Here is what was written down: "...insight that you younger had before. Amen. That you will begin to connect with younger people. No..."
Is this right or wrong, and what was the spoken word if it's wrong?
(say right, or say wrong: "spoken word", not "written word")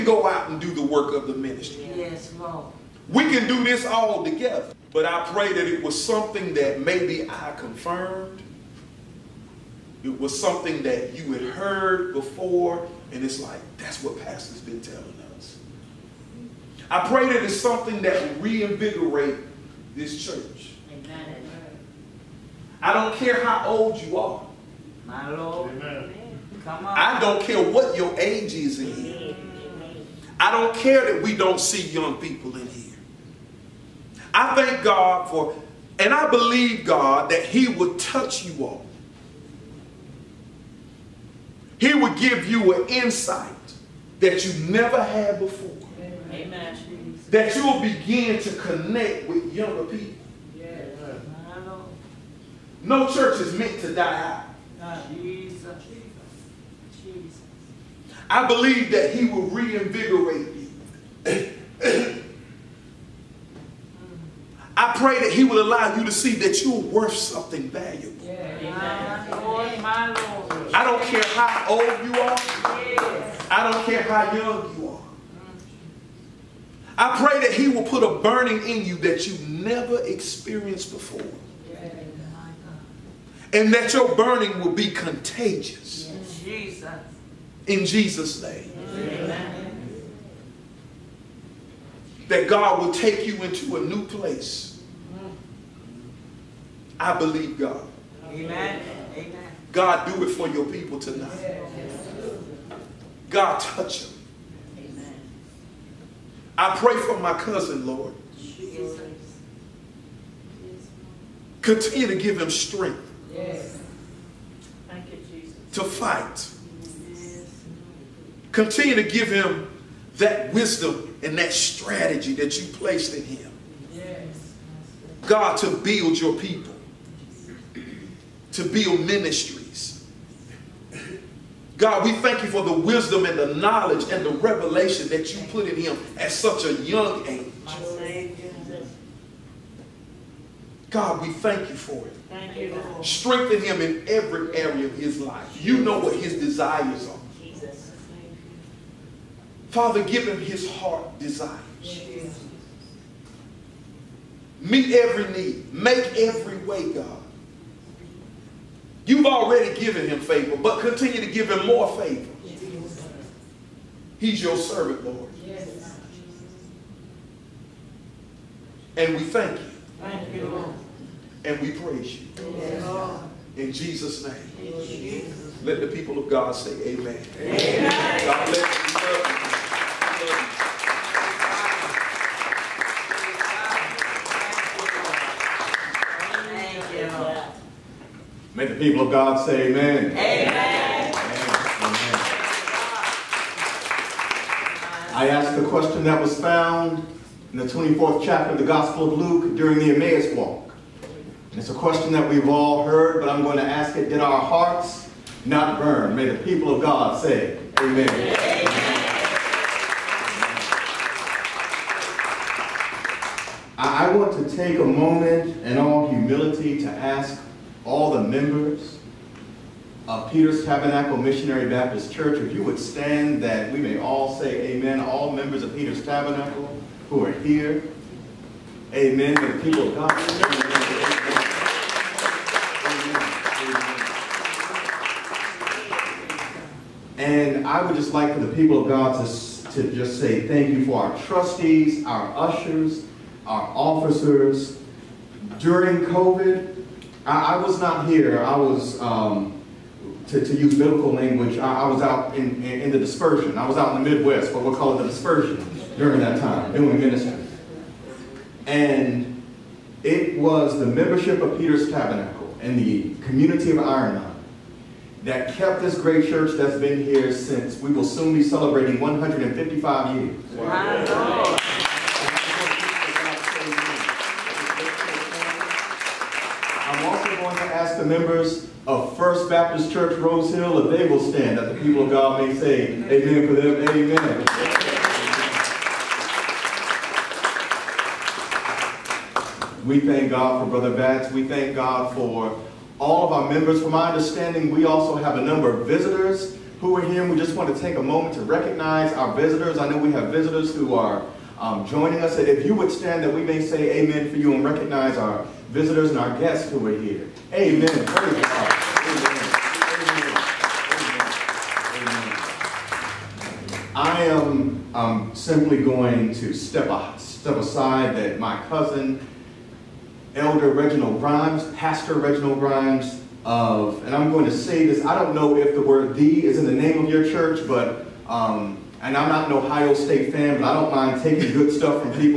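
wrong: "never", not "younger".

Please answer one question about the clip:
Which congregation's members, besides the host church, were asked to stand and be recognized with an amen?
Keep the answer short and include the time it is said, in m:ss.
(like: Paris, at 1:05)
First Baptist Church Rose Hill, at 4:39.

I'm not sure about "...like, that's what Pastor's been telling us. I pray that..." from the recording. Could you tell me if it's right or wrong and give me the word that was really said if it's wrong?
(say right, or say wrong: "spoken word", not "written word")
right.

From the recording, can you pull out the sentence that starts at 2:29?
Father, give him his heart desires.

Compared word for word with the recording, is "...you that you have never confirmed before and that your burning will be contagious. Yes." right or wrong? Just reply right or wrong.
wrong.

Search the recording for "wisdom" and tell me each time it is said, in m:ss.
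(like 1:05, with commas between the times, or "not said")
2:00, 2:12.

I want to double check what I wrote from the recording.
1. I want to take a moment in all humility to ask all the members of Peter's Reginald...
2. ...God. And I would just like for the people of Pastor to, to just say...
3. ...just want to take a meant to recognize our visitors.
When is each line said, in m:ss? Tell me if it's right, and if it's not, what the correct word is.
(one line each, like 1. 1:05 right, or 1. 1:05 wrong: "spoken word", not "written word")
1. 3:33 wrong: "Tabernacle", not "Reginald"
2. 3:49 wrong: "God", not "Pastor"
3. 4:57 wrong: "moment", not "meant".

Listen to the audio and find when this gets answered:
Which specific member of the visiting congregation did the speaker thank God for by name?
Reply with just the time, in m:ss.
4:50.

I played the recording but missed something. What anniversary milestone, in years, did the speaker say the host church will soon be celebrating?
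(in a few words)
155.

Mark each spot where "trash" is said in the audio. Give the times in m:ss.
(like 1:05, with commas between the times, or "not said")
not said.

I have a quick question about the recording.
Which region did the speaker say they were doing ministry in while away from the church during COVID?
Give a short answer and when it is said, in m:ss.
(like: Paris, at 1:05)
Midwest, at 4:14.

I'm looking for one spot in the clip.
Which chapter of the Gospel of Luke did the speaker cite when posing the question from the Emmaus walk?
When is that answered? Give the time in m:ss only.
3:17.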